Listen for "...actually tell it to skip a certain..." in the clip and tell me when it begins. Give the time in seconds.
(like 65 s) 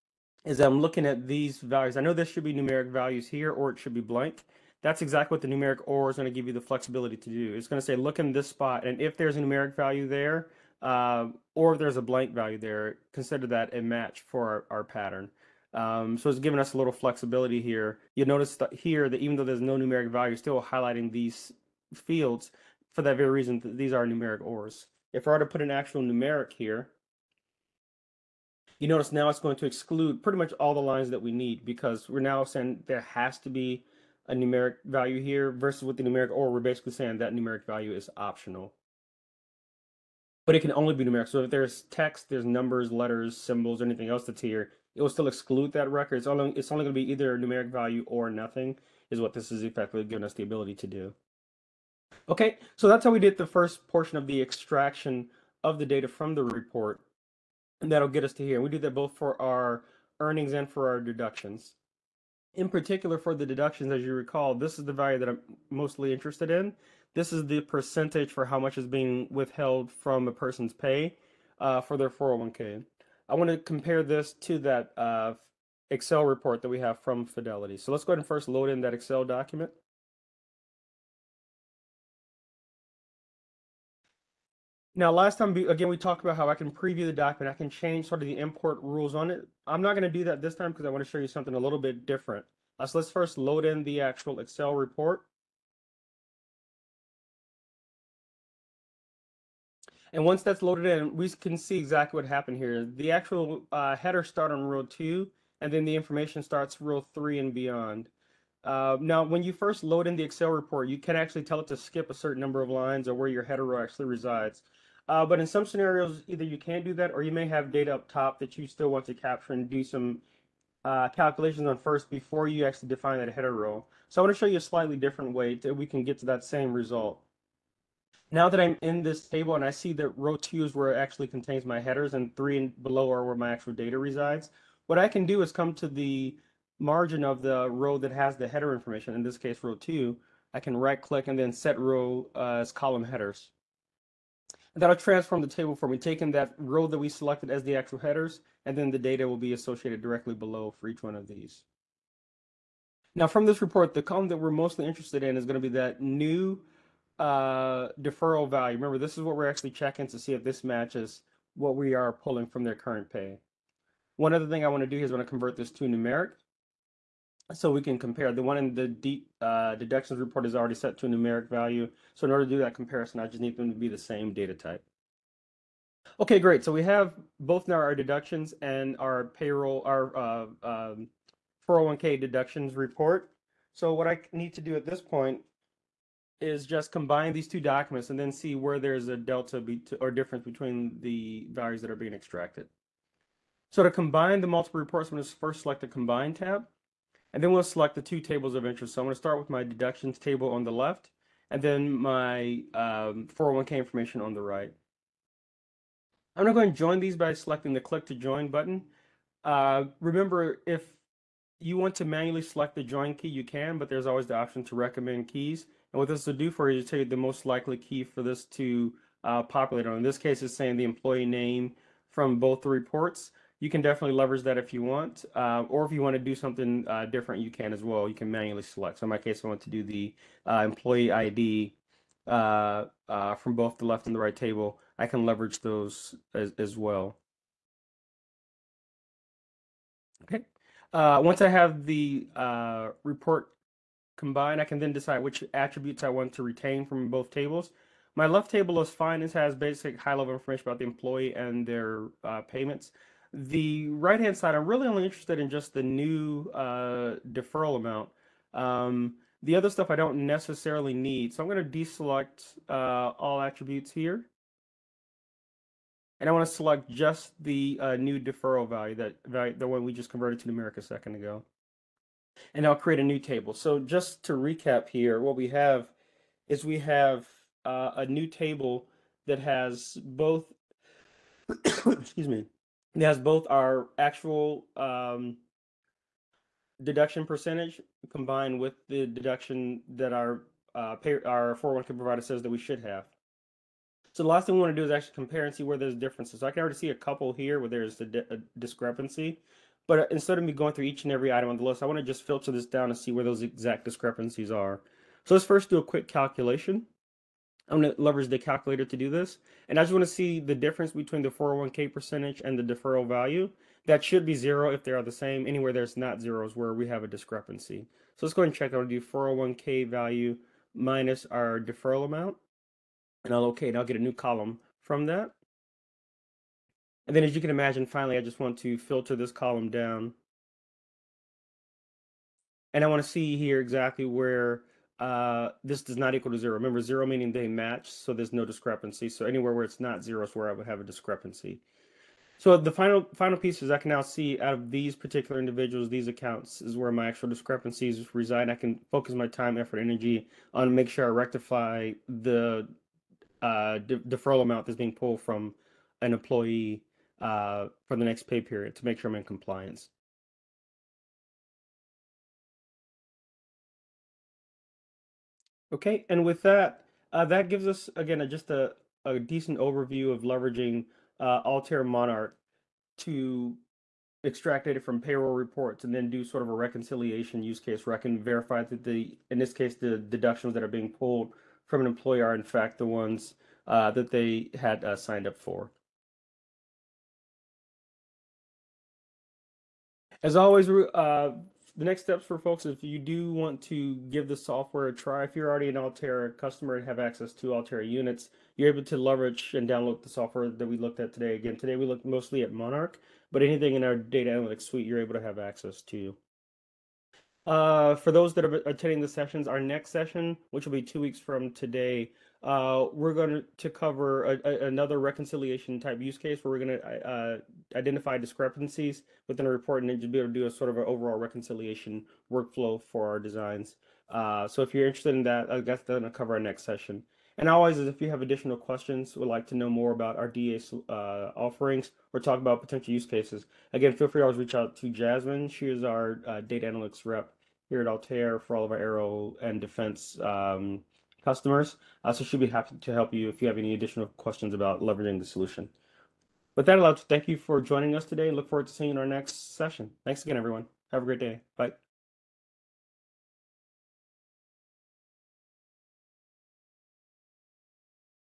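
111 s.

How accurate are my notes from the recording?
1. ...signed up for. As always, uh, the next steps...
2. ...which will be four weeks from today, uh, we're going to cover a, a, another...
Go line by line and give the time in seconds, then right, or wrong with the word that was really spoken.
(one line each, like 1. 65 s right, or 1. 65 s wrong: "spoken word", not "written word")
1. 384 s right
2. 410 s wrong: "two", not "four".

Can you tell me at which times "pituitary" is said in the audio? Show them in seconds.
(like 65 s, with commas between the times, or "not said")
not said.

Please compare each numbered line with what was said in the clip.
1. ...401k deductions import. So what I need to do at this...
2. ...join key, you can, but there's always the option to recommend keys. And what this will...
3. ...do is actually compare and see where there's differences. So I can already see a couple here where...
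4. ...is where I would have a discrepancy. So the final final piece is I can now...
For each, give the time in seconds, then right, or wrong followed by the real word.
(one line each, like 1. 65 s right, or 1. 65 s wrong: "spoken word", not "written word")
1. 181 s wrong: "report", not "import"
2. 212 s right
3. 294 s right
4. 340 s right.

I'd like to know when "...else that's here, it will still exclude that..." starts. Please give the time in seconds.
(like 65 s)
44 s.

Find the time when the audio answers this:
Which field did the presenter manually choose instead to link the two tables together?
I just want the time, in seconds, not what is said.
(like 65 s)
230 s.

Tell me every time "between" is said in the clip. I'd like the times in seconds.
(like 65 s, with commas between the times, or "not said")
190 s, 310 s.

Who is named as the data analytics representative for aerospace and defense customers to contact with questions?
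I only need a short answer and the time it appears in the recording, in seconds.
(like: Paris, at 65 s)
Jasmine, at 434 s.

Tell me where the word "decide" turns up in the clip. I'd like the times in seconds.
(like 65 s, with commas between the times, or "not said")
244 s.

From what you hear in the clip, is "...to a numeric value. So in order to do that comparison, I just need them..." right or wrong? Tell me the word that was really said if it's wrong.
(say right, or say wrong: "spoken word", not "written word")
right.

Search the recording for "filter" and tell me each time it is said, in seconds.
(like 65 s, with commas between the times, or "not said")
302 s, 328 s.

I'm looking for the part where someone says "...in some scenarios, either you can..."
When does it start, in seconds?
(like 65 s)
115 s.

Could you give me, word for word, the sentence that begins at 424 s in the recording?
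Uh, so if you're interested in that, uh, that's going to cover our next session.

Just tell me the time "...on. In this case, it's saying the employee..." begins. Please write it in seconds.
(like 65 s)
219 s.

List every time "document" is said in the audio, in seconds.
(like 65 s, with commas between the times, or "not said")
79 s, 87 s, 187 s.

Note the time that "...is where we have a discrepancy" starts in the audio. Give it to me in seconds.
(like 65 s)
316 s.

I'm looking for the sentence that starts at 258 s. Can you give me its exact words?
Um, the other stuff I don't necessarily need.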